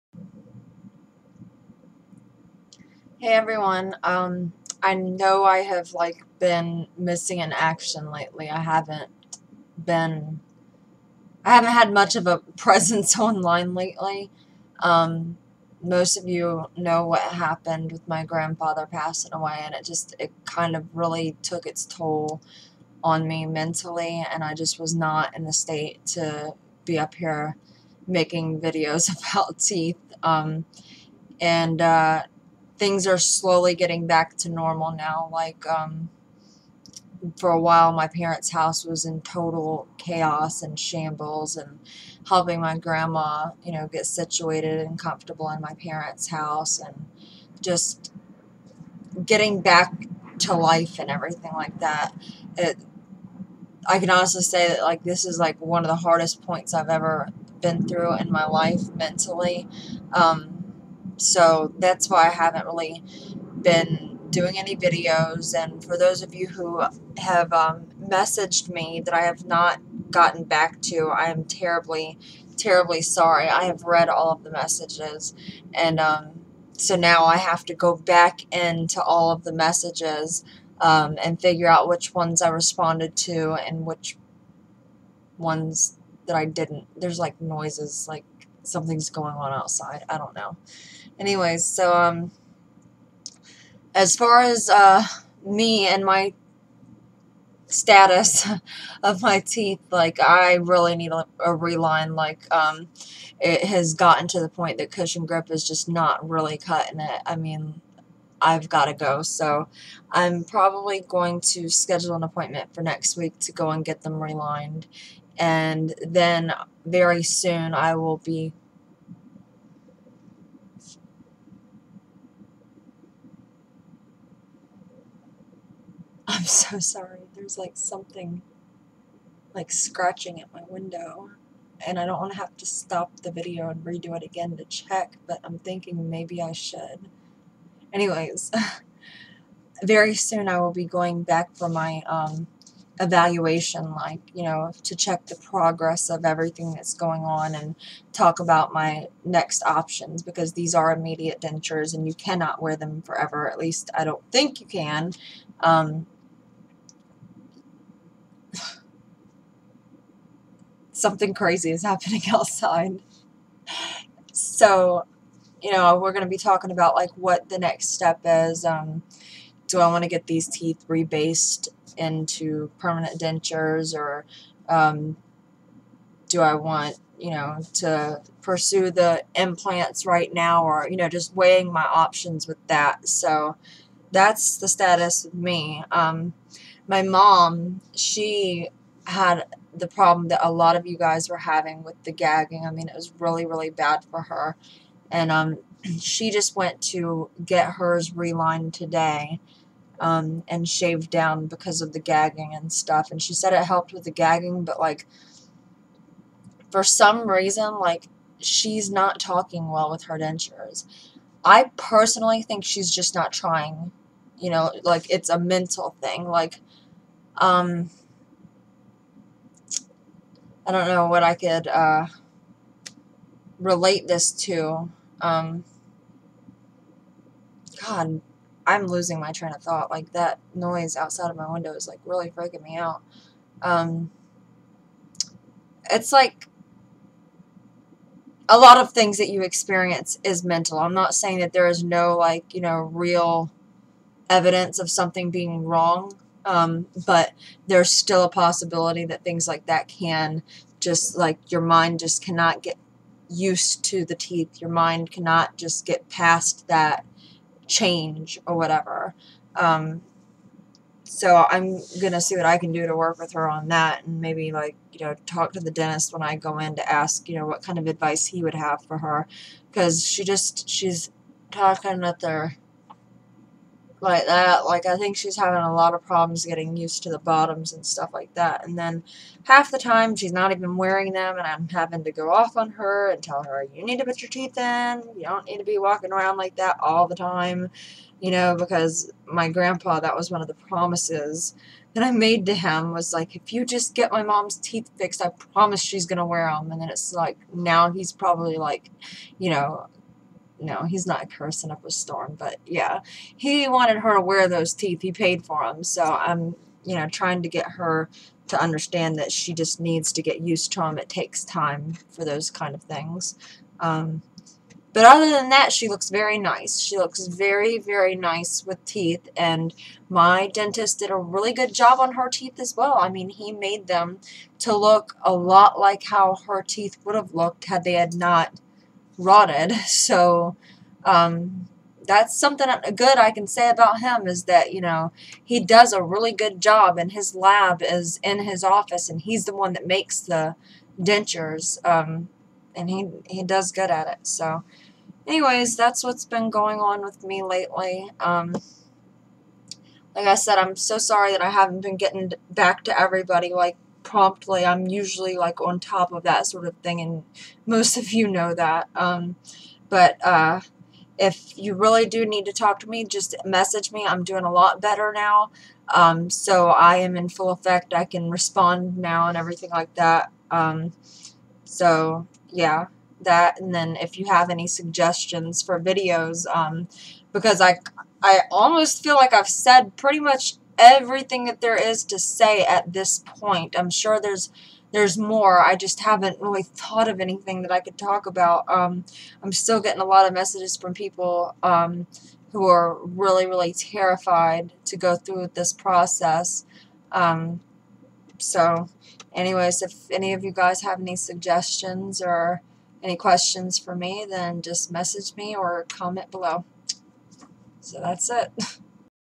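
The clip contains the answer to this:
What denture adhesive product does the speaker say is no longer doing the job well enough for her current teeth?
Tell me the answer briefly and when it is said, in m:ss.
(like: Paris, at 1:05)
Cushion Grip, at 1:44.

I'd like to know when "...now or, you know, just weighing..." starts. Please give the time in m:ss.
3:00.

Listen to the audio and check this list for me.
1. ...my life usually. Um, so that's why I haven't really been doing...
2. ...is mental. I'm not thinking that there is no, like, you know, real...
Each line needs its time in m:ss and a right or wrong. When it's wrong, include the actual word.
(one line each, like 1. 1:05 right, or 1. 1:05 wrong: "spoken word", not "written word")
1. 0:58 wrong: "mentally", not "usually"
2. 4:00 wrong: "saying", not "thinking".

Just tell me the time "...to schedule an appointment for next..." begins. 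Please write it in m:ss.
1:51.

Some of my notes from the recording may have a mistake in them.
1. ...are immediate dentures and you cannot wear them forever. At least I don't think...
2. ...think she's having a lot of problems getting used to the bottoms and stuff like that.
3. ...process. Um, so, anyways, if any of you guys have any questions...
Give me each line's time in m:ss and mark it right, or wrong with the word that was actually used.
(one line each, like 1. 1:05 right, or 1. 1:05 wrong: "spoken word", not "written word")
1. 2:30 right
2. 4:34 right
3. 6:35 wrong: "suggestions", not "questions".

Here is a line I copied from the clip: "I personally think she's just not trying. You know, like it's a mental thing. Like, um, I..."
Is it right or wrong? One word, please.
right.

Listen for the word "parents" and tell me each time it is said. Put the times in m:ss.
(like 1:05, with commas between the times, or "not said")
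0:38, 0:45.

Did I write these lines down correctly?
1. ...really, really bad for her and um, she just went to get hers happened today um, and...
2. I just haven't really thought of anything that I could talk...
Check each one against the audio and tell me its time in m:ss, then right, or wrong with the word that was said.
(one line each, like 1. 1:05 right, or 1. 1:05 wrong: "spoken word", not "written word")
1. 3:13 wrong: "relined", not "happened"
2. 6:25 right.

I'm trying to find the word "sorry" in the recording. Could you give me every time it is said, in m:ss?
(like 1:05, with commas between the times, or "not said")
1:13, 2:06, 5:50.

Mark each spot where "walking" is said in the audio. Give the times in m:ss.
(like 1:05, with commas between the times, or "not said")
4:45.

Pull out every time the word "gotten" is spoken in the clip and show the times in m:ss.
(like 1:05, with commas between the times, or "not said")
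1:10, 1:43.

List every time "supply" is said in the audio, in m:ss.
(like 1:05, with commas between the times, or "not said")
not said.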